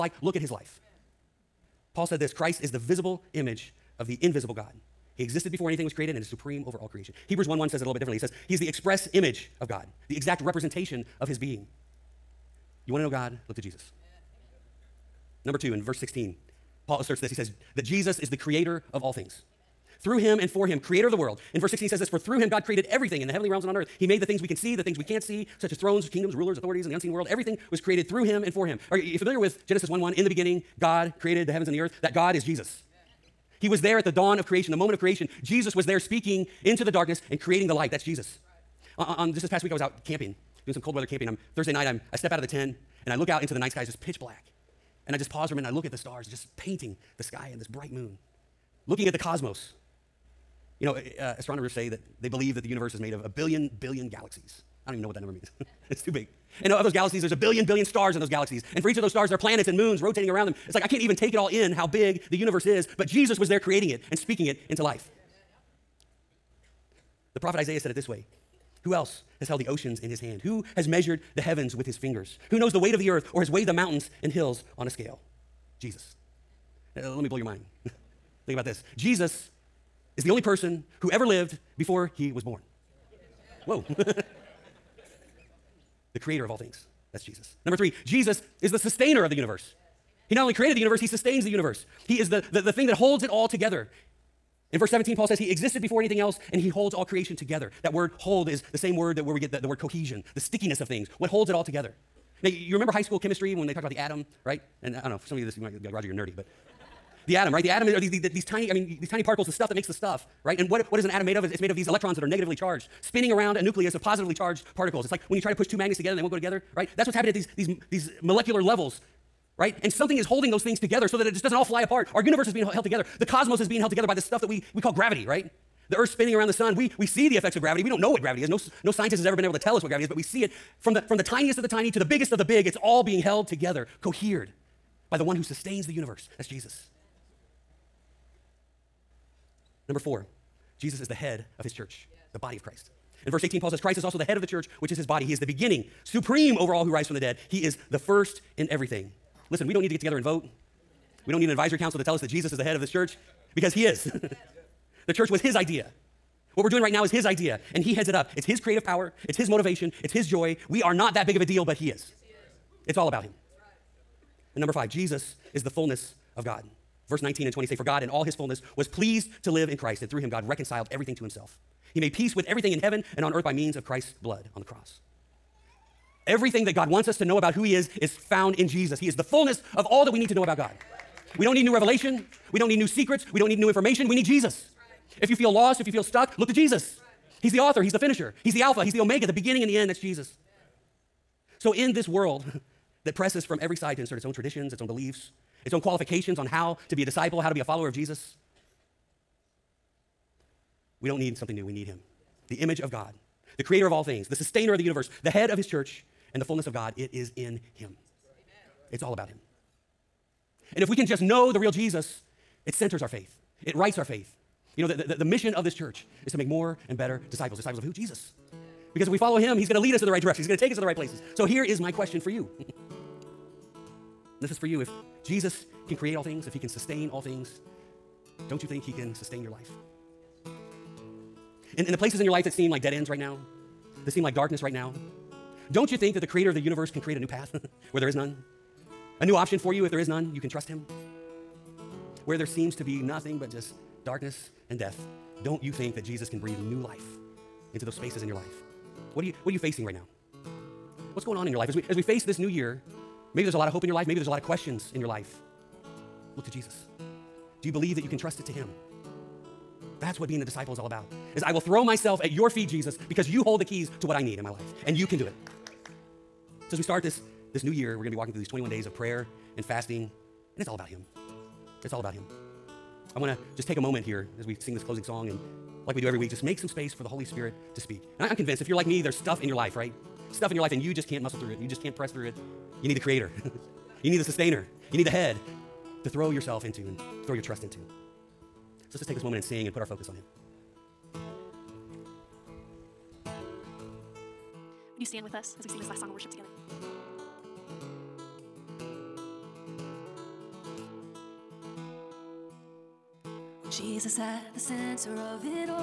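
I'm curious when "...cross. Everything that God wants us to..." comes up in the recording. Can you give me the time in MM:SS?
02:54.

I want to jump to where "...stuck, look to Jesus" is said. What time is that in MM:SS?
03:06.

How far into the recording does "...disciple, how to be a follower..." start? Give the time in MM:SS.
03:17.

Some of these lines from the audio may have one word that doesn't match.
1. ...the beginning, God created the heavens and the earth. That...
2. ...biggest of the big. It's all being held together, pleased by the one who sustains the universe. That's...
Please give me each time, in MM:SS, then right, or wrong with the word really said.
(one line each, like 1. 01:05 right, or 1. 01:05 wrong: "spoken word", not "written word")
1. 00:30 right
2. 02:12 wrong: "cohered", not "pleased".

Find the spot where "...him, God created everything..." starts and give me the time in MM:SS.
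00:22.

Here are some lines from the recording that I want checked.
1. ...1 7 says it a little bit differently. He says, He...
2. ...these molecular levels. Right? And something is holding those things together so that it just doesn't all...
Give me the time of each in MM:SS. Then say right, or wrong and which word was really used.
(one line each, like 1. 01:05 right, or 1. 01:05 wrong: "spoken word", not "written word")
1. 00:07 wrong: "1", not "7"
2. 01:57 right.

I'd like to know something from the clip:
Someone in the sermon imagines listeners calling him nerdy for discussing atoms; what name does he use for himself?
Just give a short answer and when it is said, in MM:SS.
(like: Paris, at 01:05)
Roger, at 01:45.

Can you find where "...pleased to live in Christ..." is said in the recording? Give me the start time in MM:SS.
02:48.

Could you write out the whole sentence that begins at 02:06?
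We, we see the effects of gravity.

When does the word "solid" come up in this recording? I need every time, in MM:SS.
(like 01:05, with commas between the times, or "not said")
not said.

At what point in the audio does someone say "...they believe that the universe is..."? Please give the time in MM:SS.
00:52.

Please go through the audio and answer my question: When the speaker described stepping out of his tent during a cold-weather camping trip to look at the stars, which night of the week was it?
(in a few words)
Thursday.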